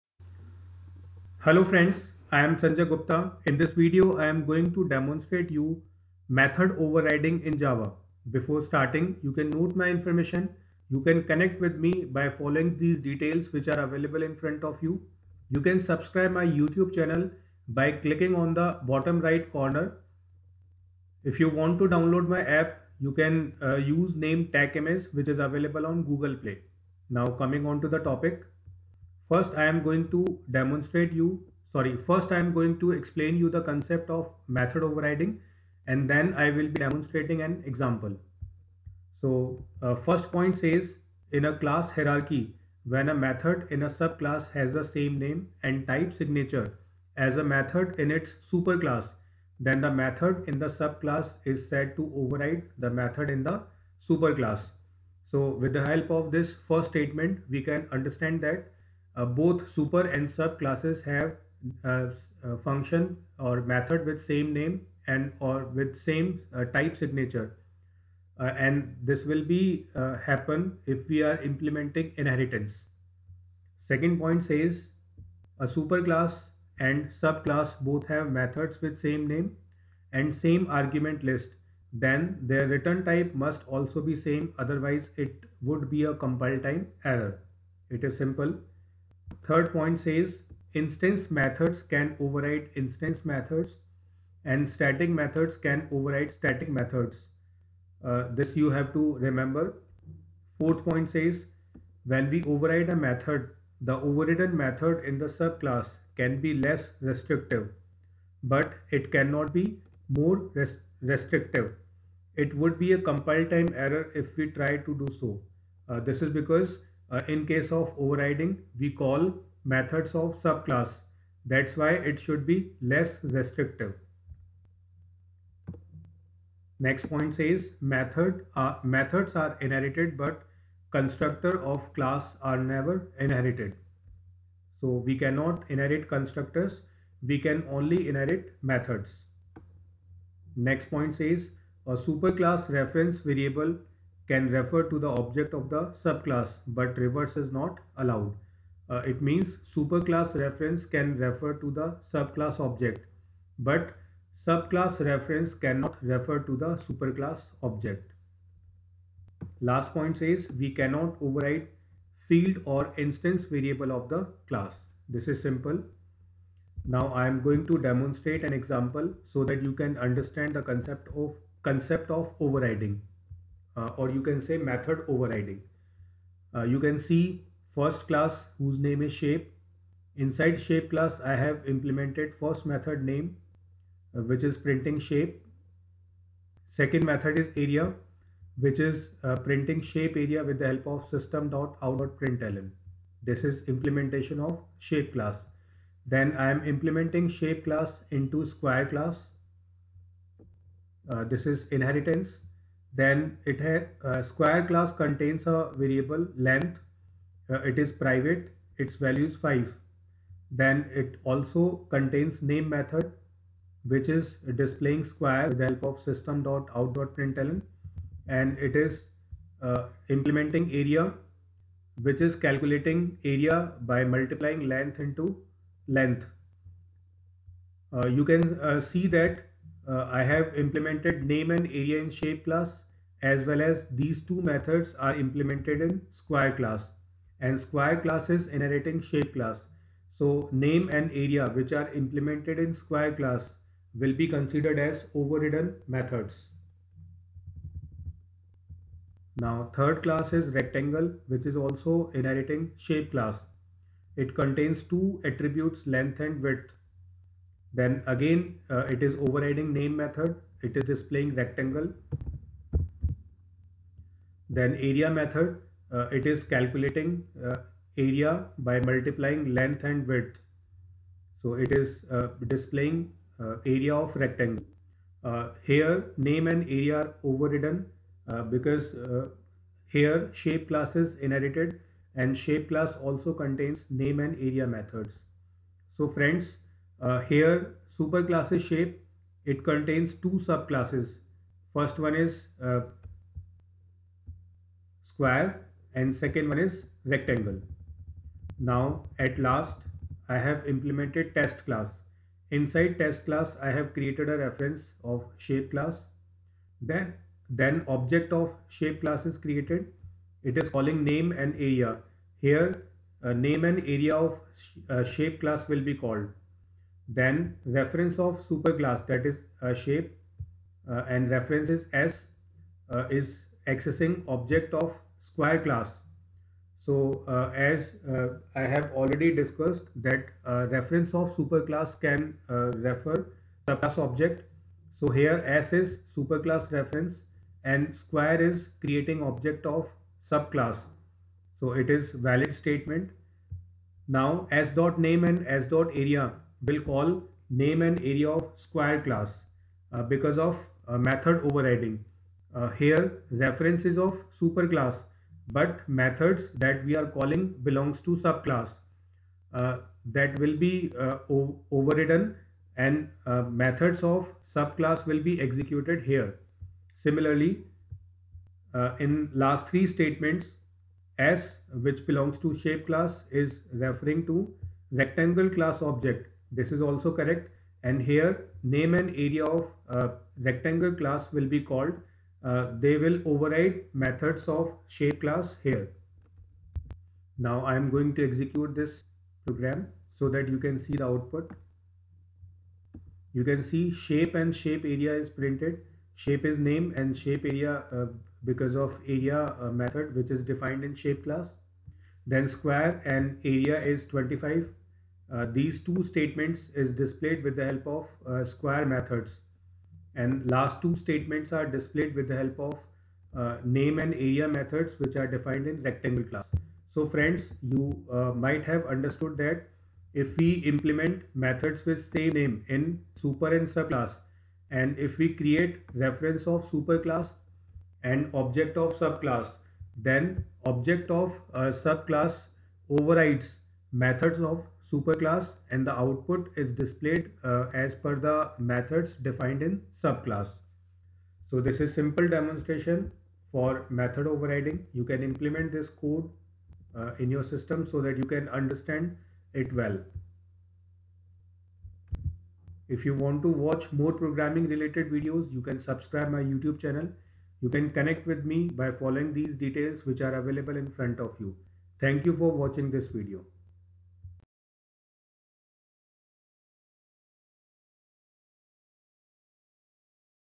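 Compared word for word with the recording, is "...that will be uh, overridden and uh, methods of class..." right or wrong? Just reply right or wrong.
wrong.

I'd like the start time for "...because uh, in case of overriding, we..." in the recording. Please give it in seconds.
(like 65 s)
116 s.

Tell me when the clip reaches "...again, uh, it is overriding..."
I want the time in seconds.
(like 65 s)
258 s.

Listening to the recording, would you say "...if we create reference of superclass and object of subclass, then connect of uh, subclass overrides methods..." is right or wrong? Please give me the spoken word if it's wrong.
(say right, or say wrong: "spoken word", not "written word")
wrong: "object", not "connect".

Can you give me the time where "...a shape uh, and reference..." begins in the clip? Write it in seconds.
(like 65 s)
319 s.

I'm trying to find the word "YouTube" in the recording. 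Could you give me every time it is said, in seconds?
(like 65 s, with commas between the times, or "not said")
16 s, 456 s.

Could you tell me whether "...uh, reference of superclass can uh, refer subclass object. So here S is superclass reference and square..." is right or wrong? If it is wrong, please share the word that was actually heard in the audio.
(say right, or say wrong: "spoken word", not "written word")
right.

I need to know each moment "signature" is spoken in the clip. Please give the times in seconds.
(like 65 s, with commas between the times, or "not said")
46 s, 66 s.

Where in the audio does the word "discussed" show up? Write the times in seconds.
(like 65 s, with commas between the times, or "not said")
329 s.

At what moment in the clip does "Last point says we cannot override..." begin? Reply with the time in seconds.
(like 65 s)
159 s.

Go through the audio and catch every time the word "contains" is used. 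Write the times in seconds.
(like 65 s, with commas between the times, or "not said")
204 s, 211 s, 254 s, 283 s, 289 s.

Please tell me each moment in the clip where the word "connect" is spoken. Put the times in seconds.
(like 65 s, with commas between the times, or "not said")
11 s, 457 s.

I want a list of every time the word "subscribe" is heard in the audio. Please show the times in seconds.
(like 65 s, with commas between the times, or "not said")
15 s, 455 s.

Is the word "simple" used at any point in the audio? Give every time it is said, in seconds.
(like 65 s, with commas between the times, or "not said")
88 s, 165 s, 441 s.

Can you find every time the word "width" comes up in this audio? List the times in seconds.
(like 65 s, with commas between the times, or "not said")
256 s, 270 s.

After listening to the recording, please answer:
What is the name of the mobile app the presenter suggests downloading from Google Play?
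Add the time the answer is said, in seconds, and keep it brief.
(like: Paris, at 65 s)
TechMS, at 24 s.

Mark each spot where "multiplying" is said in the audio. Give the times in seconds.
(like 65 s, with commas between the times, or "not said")
224 s, 268 s.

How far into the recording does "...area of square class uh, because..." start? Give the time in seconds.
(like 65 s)
348 s.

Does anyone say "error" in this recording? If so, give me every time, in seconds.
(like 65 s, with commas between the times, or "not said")
87 s, 113 s.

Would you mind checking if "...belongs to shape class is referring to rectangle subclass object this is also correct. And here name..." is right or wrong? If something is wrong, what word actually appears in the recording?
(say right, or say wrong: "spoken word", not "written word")
wrong: "class", not "subclass".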